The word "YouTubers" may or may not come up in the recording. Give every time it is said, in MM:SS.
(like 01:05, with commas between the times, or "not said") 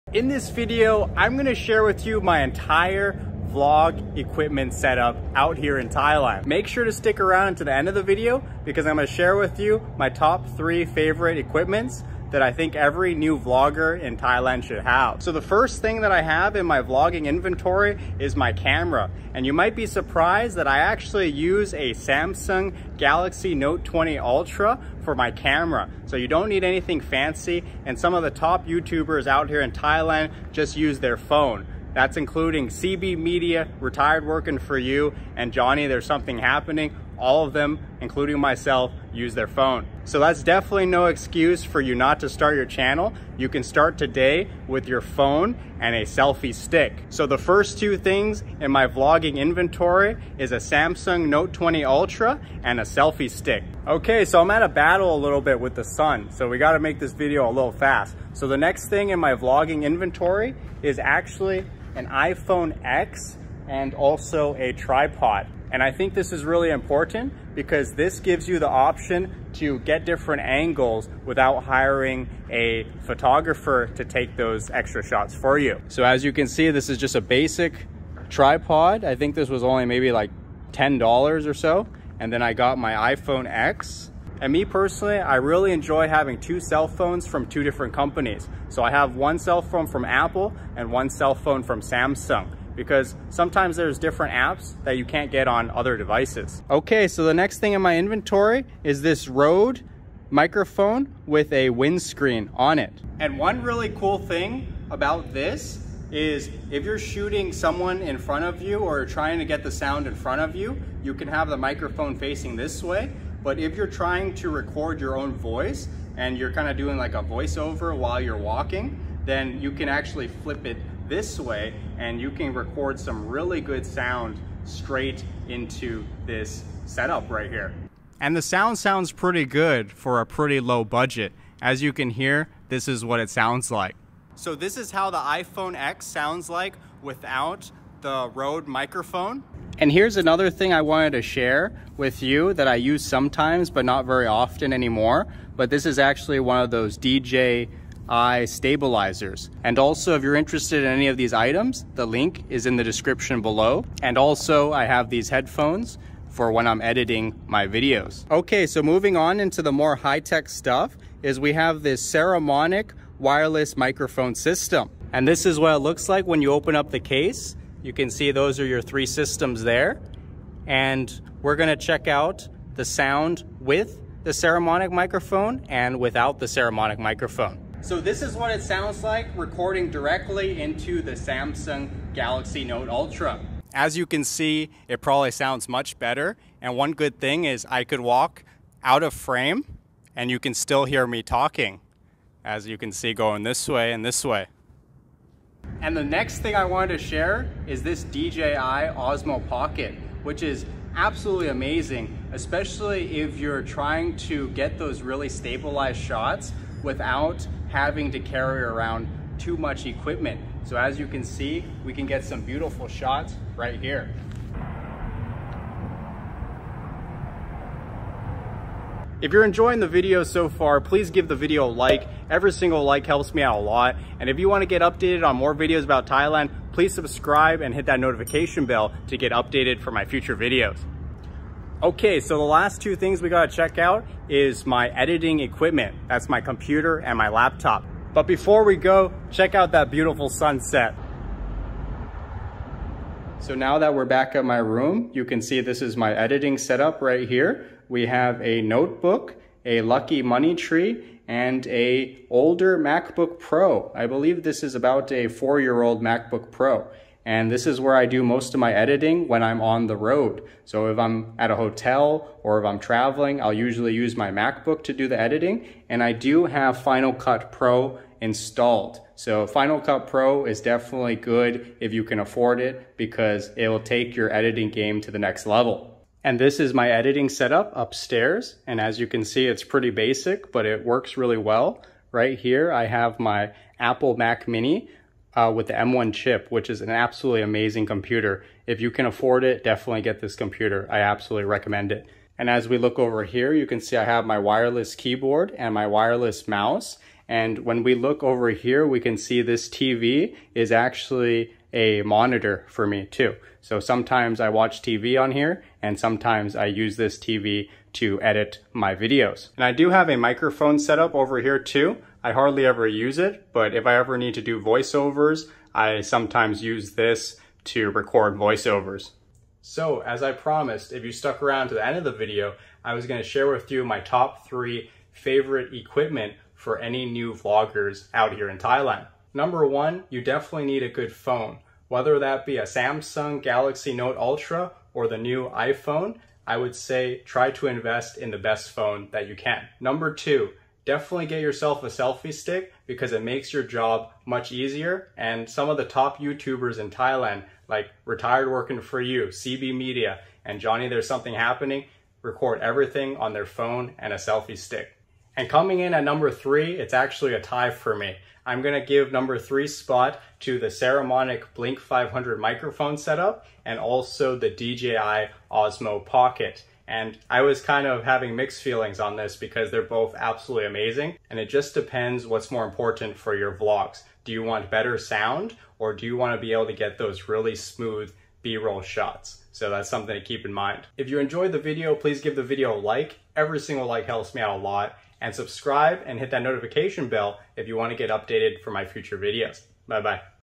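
00:28, 05:46.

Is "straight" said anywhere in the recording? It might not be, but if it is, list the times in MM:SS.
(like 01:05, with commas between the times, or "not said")
02:04.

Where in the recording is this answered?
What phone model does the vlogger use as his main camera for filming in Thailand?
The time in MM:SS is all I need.
00:21.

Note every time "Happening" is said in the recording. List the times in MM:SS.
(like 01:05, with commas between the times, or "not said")
00:36, 05:51.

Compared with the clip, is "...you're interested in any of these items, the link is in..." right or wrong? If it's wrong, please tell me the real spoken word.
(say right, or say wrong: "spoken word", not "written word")
right.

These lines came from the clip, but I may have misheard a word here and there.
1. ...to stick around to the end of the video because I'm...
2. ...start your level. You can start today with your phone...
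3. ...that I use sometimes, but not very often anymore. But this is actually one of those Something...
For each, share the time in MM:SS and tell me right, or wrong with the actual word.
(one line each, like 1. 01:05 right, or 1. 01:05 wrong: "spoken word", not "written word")
1. 00:06 right
2. 00:42 wrong: "channel", not "level"
3. 02:22 wrong: "DJI", not "Something".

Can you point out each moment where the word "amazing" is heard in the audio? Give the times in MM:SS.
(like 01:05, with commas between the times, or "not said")
03:21, 04:47, 06:10.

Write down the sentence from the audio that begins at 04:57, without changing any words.
And when we look over here, we can see this TV is actually a monitor for me too.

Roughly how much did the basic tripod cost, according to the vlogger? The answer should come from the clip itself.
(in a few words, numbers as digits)
$10.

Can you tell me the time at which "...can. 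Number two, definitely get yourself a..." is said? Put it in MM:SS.
05:39.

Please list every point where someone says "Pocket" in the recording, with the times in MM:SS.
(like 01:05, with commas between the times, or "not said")
03:19, 06:06.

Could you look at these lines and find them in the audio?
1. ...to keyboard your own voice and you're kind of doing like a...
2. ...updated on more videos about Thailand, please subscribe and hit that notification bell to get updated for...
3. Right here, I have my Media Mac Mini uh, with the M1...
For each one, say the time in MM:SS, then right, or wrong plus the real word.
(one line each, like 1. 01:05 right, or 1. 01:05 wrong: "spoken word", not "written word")
1. 01:54 wrong: "record", not "keyboard"
2. 03:44 right
3. 04:42 wrong: "Apple", not "Media".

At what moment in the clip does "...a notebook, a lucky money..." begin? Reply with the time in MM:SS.
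04:08.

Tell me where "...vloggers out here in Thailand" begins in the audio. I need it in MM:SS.
05:27.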